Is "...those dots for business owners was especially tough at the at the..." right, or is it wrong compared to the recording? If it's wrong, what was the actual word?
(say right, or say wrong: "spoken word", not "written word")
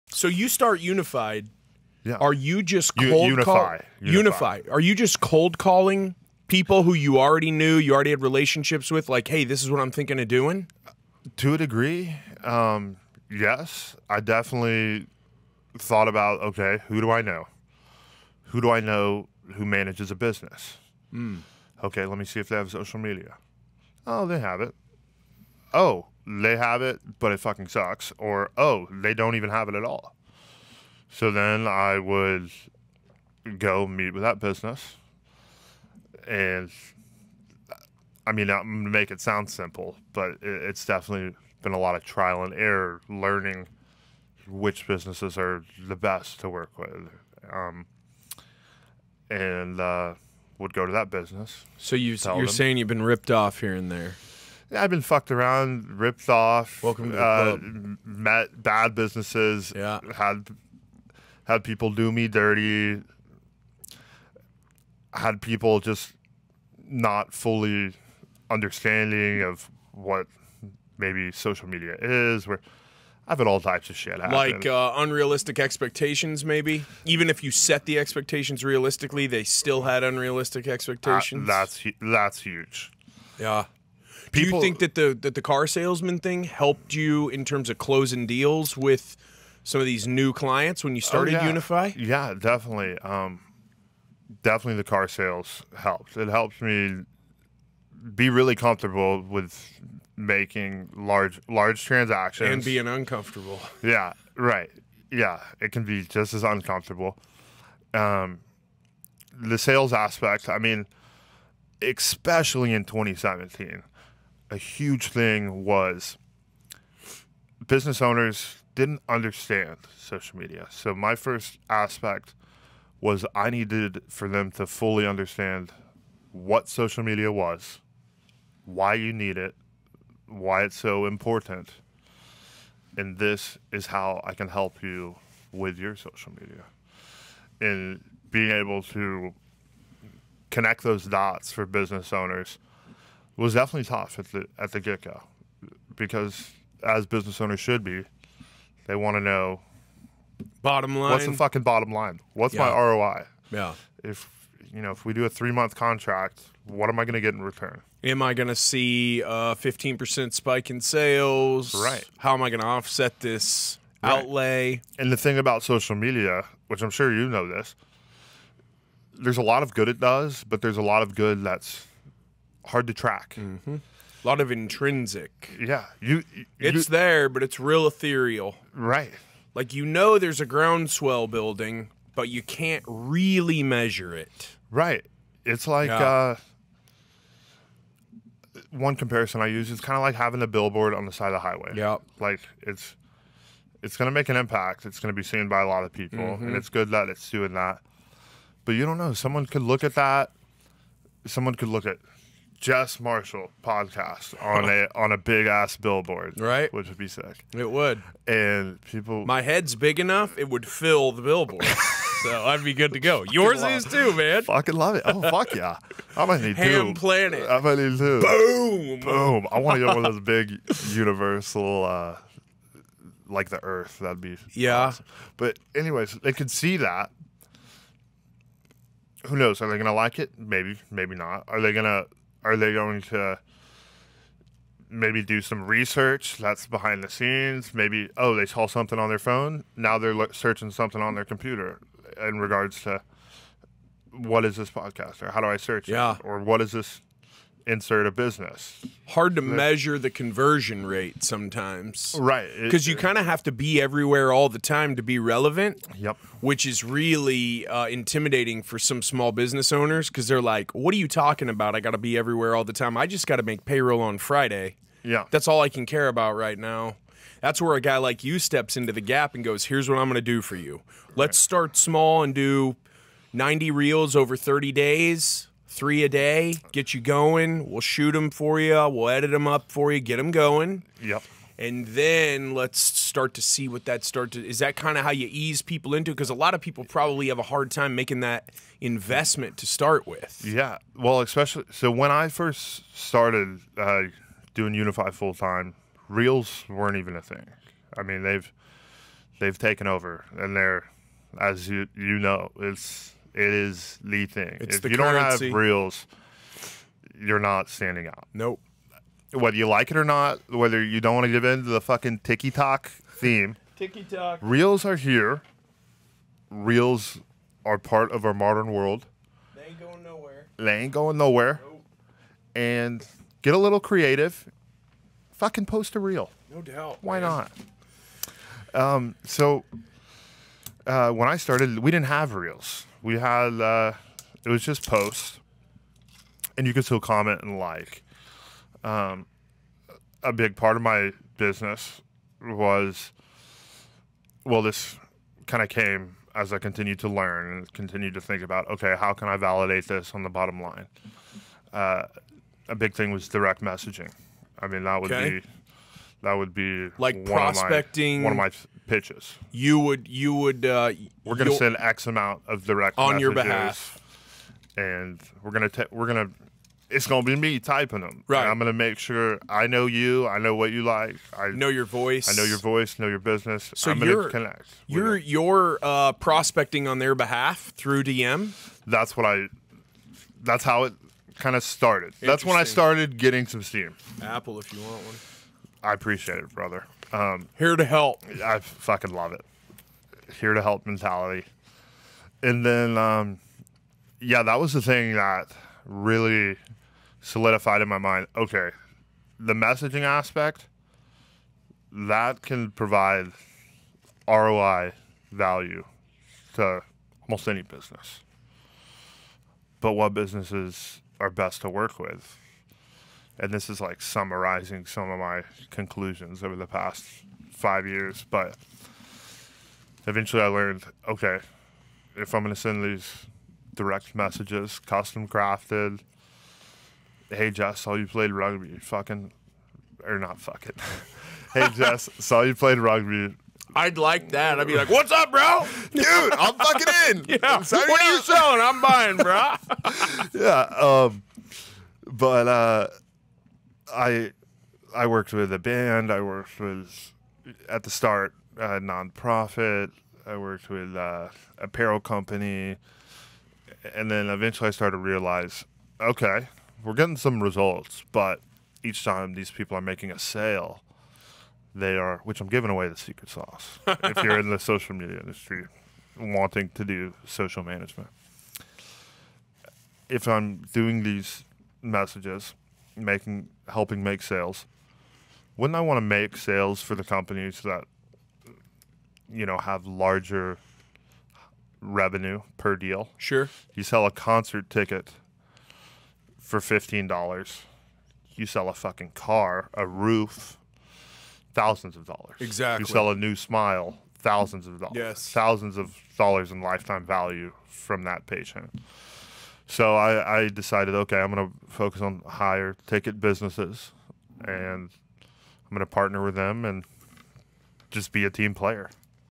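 wrong: "definitely", not "especially".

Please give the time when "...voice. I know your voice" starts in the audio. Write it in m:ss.
6:11.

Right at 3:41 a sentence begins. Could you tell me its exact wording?
uh like the earth that'd be yeah awesome.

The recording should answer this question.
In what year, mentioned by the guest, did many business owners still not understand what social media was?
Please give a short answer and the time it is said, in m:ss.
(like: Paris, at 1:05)
2017, at 1:52.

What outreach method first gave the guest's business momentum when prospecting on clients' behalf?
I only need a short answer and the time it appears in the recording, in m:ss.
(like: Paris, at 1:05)
Direct messaging, at 5:53.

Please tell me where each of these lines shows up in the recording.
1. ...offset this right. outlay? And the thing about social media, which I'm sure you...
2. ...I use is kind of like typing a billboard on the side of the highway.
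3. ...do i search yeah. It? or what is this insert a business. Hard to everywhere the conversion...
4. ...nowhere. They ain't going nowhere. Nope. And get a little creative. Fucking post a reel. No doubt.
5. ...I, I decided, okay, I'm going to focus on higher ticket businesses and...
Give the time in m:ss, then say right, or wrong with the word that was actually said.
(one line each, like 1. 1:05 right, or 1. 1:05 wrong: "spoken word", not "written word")
1. 2:42 right
2. 3:09 wrong: "having", not "typing"
3. 4:05 wrong: "measure", not "everywhere"
4. 5:20 right
5. 8:19 right.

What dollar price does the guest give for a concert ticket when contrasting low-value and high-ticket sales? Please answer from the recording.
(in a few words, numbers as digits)
$15.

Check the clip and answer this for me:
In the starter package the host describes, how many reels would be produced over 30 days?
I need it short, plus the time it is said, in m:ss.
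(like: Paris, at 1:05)
90, at 4:33.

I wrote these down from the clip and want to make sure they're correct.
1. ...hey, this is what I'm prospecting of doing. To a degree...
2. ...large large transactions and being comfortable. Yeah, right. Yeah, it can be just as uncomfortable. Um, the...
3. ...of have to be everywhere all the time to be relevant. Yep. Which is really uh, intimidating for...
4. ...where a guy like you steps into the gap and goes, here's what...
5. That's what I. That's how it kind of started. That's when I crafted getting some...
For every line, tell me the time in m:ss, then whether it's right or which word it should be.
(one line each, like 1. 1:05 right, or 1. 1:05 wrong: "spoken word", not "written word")
1. 0:09 wrong: "thinking", not "prospecting"
2. 1:40 wrong: "uncomfortable", not "comfortable"
3. 4:13 right
4. 4:27 right
5. 6:18 wrong: "started", not "crafted".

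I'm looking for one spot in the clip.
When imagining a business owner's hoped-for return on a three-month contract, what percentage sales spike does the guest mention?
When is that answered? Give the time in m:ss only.
2:39.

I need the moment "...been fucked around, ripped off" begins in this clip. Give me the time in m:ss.
0:54.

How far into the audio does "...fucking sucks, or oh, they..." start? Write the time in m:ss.
0:27.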